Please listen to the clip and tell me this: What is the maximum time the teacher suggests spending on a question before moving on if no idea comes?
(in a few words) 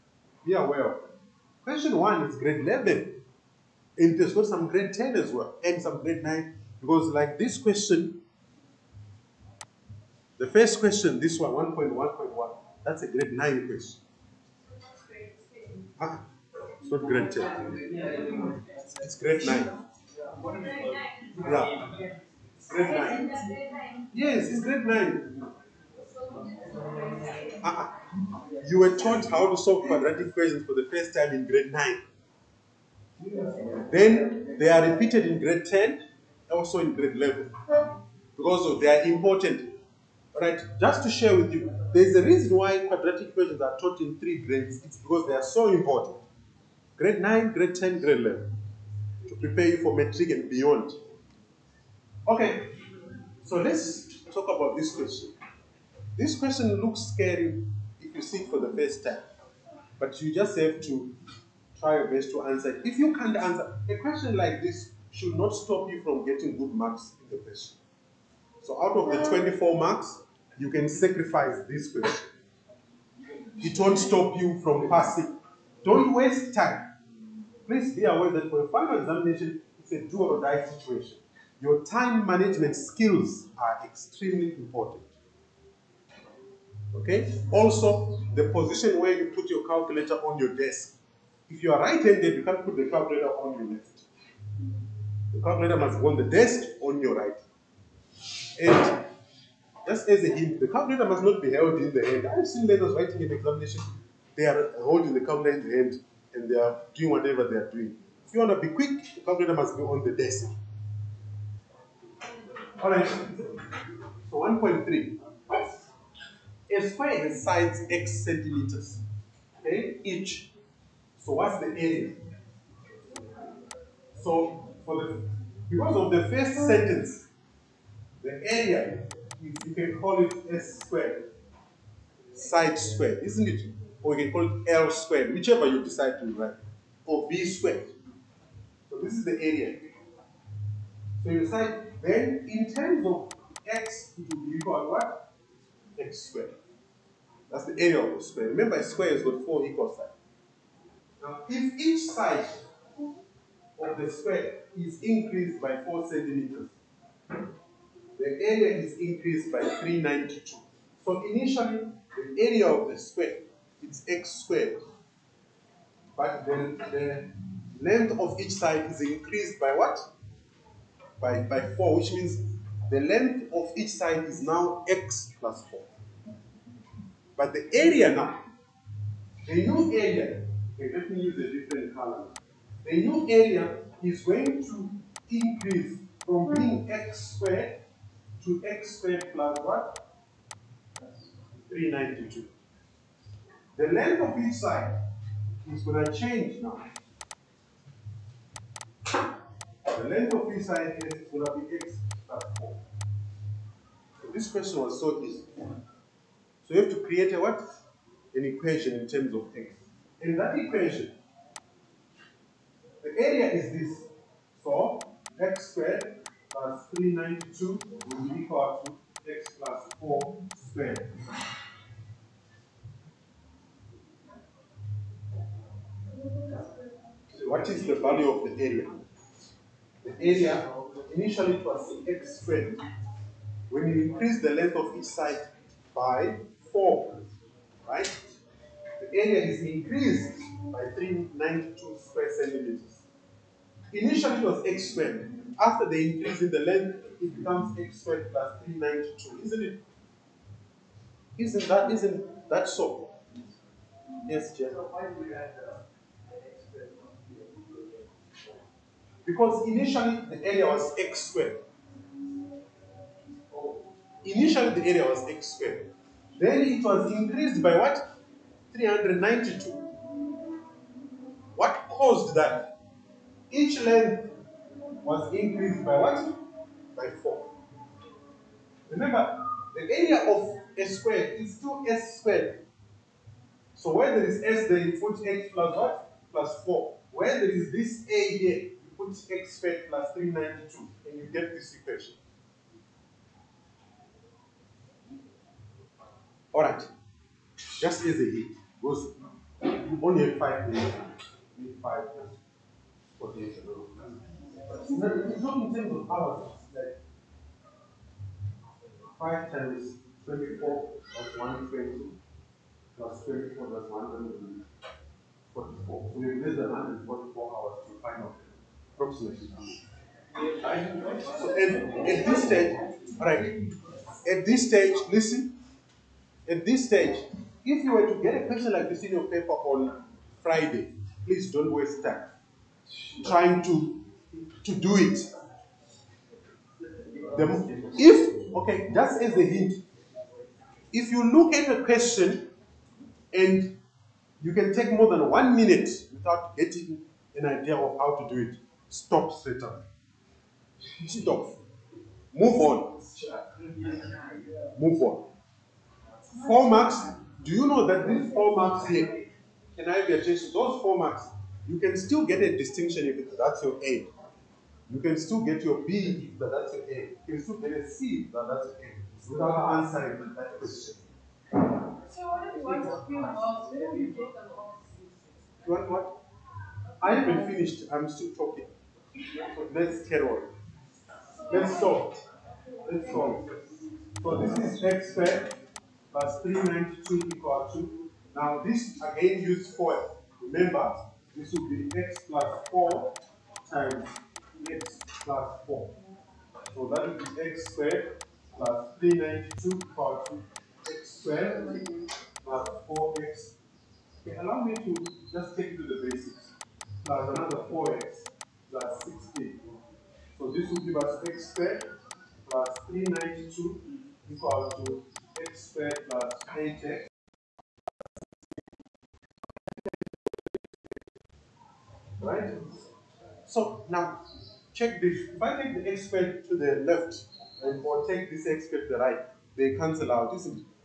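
One minute.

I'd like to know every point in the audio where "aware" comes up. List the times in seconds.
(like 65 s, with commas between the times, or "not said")
0 s, 78 s.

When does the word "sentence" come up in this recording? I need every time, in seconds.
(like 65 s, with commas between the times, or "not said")
126 s.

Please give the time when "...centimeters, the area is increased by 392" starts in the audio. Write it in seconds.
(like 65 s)
156 s.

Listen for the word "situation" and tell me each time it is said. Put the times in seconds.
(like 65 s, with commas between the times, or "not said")
80 s.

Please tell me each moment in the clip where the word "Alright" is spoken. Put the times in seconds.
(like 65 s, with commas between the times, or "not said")
112 s, 296 s.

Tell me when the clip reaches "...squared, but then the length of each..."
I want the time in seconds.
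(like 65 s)
164 s.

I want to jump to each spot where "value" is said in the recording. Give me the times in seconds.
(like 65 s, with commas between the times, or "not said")
227 s.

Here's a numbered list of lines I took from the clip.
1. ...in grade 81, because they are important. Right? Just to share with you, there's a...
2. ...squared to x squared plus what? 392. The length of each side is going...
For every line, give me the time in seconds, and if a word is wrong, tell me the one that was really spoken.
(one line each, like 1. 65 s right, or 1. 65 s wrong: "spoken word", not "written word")
1. 36 s wrong: "11", not "81"
2. 187 s right.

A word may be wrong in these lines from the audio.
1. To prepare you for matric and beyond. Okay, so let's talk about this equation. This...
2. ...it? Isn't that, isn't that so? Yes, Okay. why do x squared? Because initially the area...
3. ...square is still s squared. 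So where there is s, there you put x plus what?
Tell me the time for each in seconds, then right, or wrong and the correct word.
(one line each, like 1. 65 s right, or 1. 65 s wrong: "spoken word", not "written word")
1. 49 s wrong: "question", not "equation"
2. 249 s wrong: "Jeff", not "Okay"
3. 280 s right.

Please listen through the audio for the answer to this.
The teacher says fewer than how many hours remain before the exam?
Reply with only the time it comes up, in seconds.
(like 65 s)
316 s.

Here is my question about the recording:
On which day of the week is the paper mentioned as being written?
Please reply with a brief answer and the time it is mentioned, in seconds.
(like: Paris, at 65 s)
Friday, at 330 s.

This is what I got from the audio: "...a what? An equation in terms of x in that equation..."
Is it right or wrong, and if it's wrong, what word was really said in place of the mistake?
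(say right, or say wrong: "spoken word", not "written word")
right.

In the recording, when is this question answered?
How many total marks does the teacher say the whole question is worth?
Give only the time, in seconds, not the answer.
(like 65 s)
69 s.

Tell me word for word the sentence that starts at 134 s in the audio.
Or you can call it L squared, whichever you decide to write, or B squared.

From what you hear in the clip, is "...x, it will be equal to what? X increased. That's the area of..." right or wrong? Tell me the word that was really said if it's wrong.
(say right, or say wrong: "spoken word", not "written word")
wrong: "squared", not "increased".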